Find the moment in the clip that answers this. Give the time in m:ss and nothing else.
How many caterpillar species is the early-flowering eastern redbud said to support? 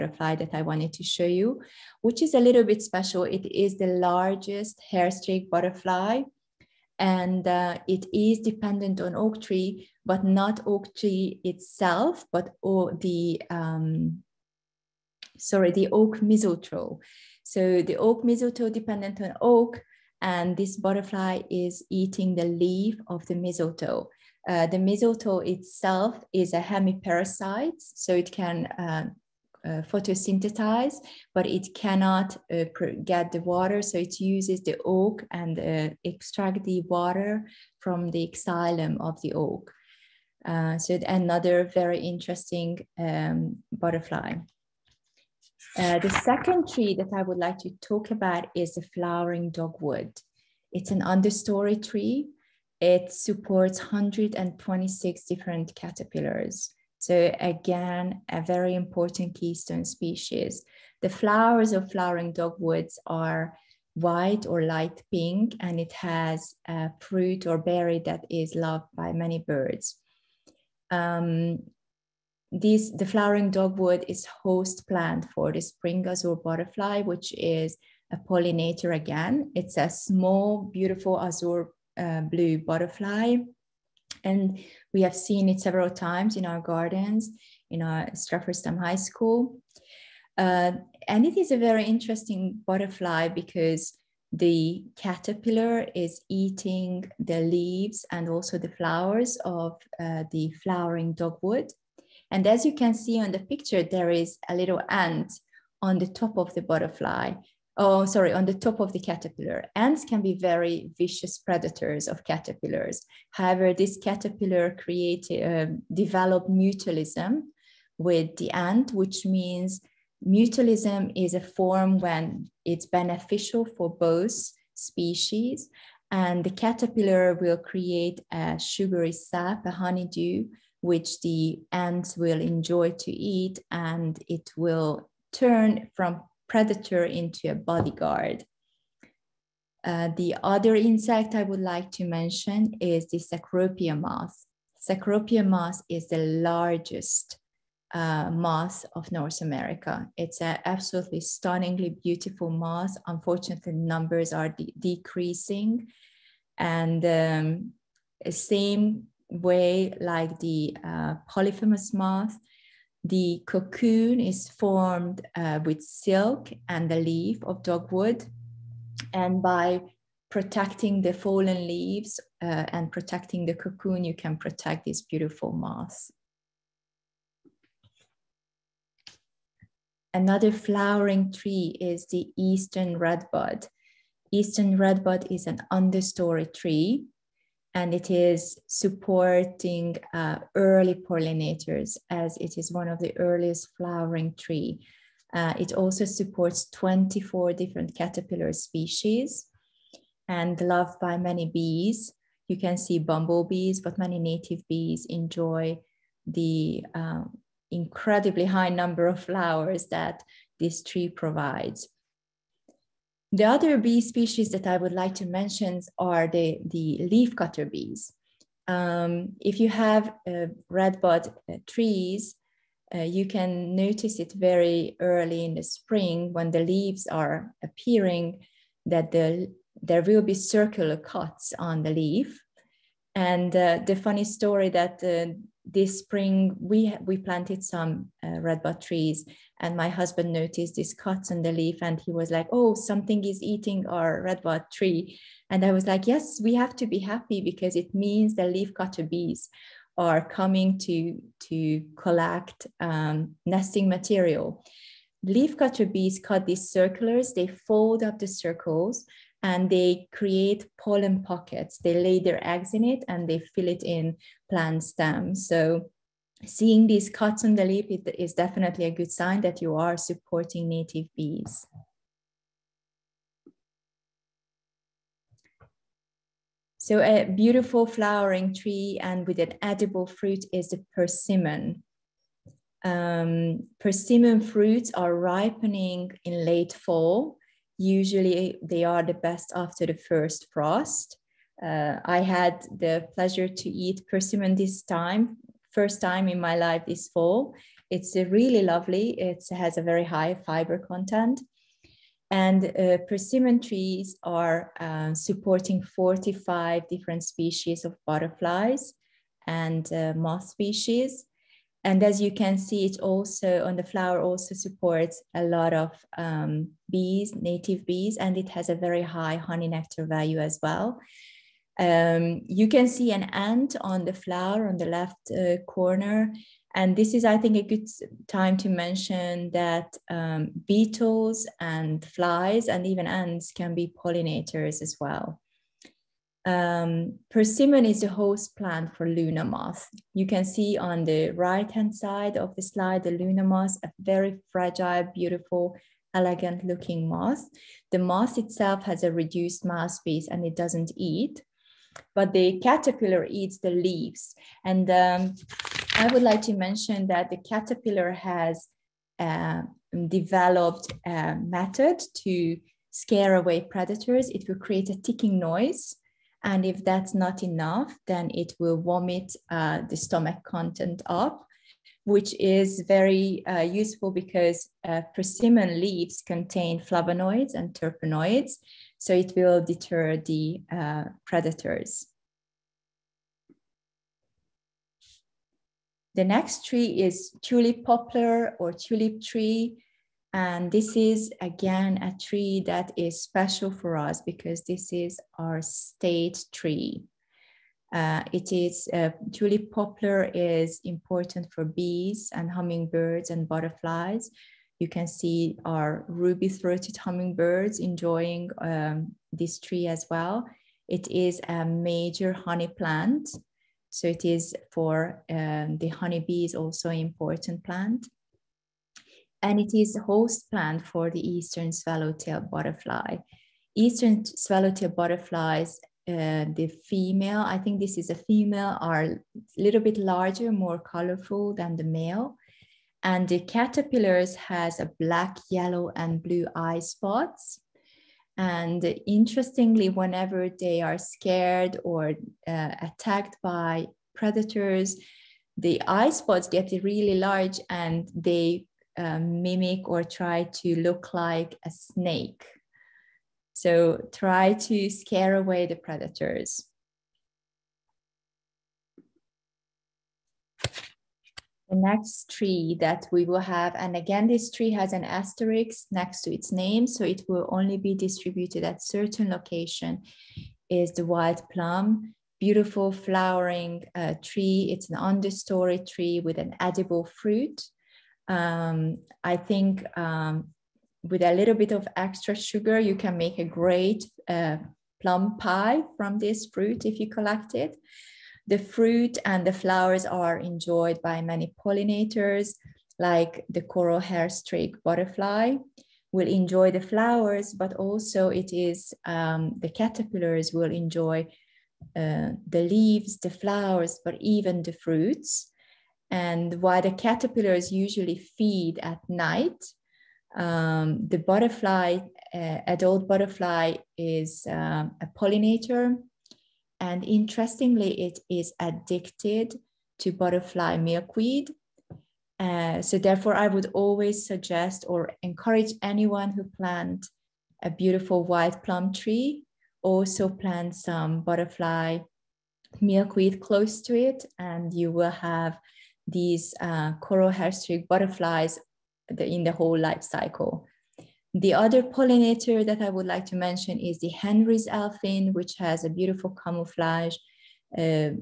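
3:16.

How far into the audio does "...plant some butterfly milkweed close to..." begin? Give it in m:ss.
8:50.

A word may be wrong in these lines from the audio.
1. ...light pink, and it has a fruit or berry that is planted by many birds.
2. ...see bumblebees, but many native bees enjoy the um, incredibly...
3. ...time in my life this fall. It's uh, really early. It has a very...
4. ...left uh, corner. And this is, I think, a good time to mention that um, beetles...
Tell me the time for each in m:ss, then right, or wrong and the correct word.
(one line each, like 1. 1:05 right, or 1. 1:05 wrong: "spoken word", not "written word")
1. 1:04 wrong: "loved", not "planted"
2. 3:22 right
3. 4:56 wrong: "lovely", not "early"
4. 5:24 right.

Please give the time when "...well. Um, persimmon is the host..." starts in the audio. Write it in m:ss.
5:35.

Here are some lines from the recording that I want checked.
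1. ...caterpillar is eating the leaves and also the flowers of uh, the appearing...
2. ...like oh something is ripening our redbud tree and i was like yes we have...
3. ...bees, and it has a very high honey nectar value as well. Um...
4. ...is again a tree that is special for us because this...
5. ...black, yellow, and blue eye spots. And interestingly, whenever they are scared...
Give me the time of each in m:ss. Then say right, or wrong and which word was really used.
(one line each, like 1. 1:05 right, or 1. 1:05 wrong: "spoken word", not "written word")
1. 1:34 wrong: "flowering", not "appearing"
2. 4:02 wrong: "eating", not "ripening"
3. 5:17 right
4. 6:30 right
5. 7:15 right.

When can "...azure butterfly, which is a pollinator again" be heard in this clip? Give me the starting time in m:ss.
1:16.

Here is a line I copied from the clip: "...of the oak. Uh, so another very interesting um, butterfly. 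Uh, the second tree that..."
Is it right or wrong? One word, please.
right.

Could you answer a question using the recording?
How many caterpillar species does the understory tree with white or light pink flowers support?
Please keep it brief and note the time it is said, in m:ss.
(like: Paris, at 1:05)
126, at 0:53.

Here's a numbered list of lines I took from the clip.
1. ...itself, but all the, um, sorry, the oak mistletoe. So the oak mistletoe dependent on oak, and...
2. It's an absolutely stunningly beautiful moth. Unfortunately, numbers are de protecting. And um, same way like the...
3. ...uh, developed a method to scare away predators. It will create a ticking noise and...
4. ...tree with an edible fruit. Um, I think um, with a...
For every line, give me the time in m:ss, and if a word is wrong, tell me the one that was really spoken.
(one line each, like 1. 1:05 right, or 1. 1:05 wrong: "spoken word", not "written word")
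1. 0:11 right
2. 2:30 wrong: "decreasing", not "protecting"
3. 5:59 right
4. 7:55 right.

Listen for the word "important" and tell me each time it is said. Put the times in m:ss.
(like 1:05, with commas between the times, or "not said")
0:58, 6:40, 6:56.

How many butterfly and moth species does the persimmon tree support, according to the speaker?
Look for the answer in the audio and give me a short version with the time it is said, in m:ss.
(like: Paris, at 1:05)
45, at 5:05.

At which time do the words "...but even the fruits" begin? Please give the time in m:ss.
8:24.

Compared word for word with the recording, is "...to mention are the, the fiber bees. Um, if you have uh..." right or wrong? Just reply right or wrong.
wrong.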